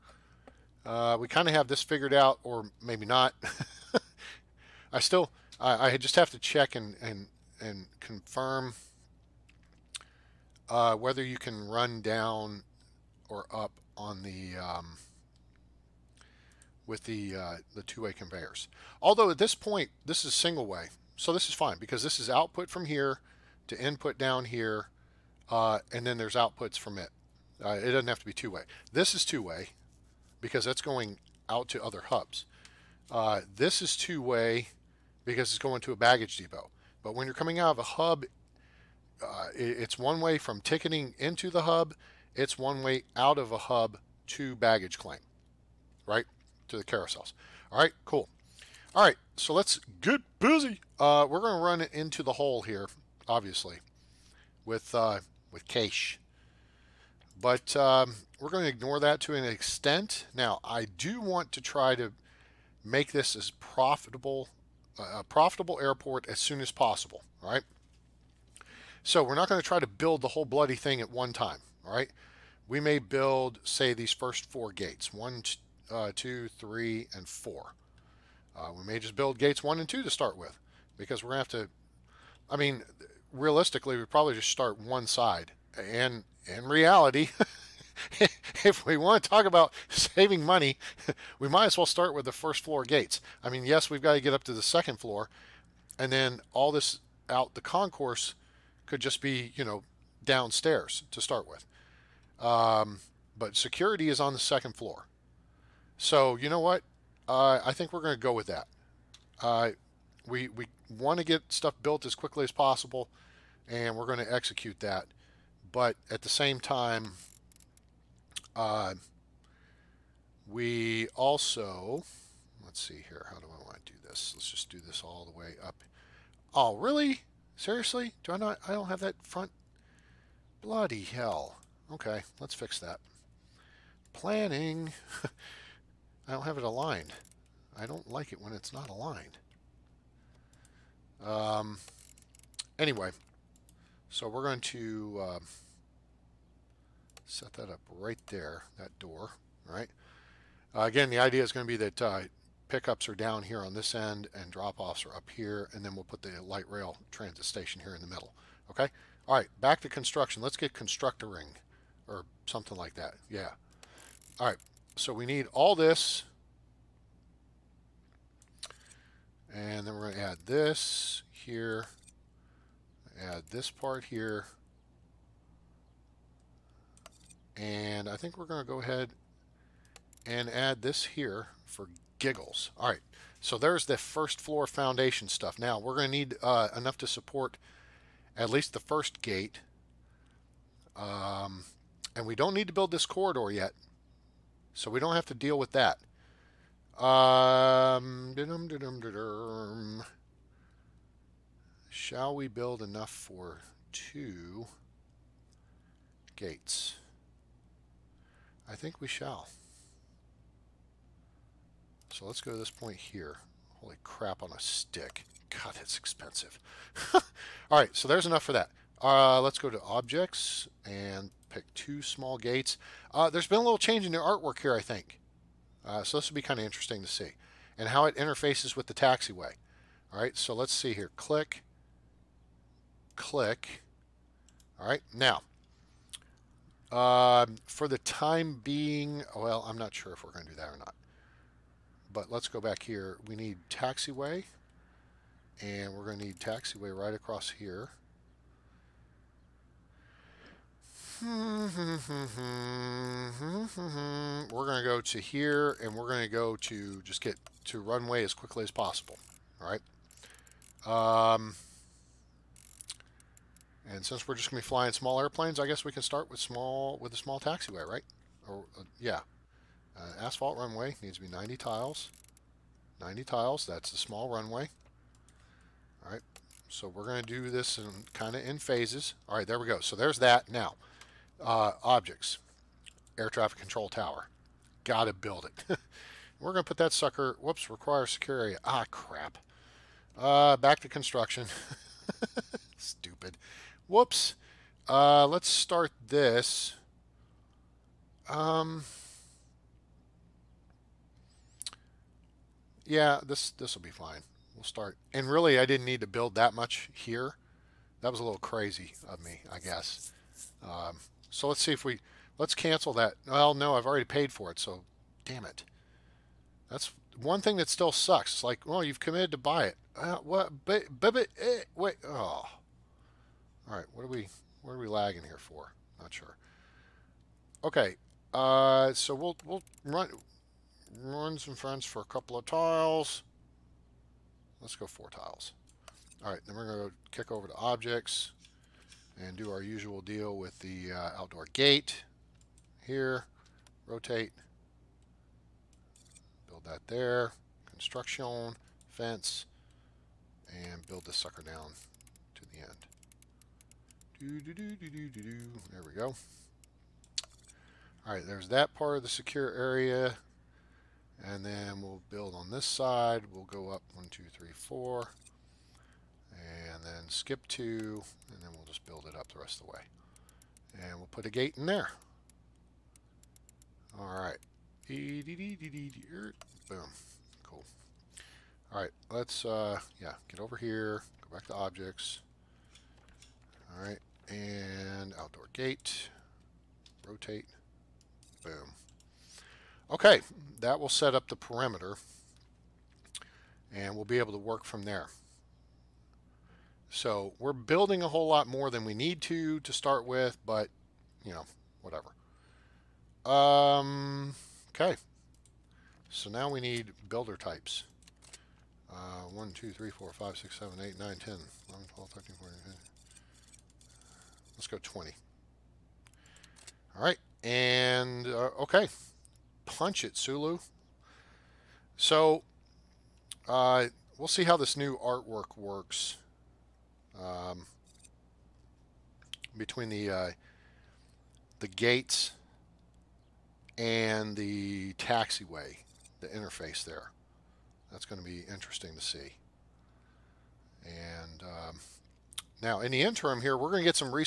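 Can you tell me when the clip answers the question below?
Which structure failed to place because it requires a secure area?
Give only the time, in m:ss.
4:43.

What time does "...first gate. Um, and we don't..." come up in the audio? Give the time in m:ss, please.
3:08.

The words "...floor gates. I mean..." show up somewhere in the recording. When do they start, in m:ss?
1:32.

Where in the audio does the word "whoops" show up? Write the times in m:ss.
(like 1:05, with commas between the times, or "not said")
4:47, 4:53.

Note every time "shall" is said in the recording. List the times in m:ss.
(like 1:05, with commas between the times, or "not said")
3:21, 3:29.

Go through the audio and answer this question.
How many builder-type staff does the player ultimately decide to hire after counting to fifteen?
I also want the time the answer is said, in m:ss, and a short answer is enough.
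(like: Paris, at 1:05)
20, at 6:54.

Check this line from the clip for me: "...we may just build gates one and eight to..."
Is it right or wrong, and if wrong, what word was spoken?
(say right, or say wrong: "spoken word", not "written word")
wrong: "two", not "eight".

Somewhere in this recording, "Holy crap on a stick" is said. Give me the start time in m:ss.
3:33.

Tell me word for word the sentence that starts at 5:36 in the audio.
All right, then we're going to kick over to objects and do our usual deal with the uh, outdoor gate here.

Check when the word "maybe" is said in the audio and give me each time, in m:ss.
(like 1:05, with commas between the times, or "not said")
0:02.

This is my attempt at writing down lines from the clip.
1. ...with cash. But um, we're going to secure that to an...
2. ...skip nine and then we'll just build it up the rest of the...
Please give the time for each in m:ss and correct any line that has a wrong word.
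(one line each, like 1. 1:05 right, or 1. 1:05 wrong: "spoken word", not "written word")
1. 0:55 wrong: "ignore", not "secure"
2. 6:07 wrong: "two", not "nine".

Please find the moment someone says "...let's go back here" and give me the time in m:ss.
4:02.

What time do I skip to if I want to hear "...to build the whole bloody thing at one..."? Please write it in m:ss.
1:09.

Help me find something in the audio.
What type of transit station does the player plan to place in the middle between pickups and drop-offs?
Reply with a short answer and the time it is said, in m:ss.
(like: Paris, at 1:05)
light rail transit station, at 2:36.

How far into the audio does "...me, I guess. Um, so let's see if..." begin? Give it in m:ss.
5:09.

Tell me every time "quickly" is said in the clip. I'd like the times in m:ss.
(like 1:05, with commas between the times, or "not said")
1:52, 4:18.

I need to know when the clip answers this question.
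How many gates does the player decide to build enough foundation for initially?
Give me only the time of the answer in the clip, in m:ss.
3:23.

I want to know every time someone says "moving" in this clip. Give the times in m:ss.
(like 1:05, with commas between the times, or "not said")
not said.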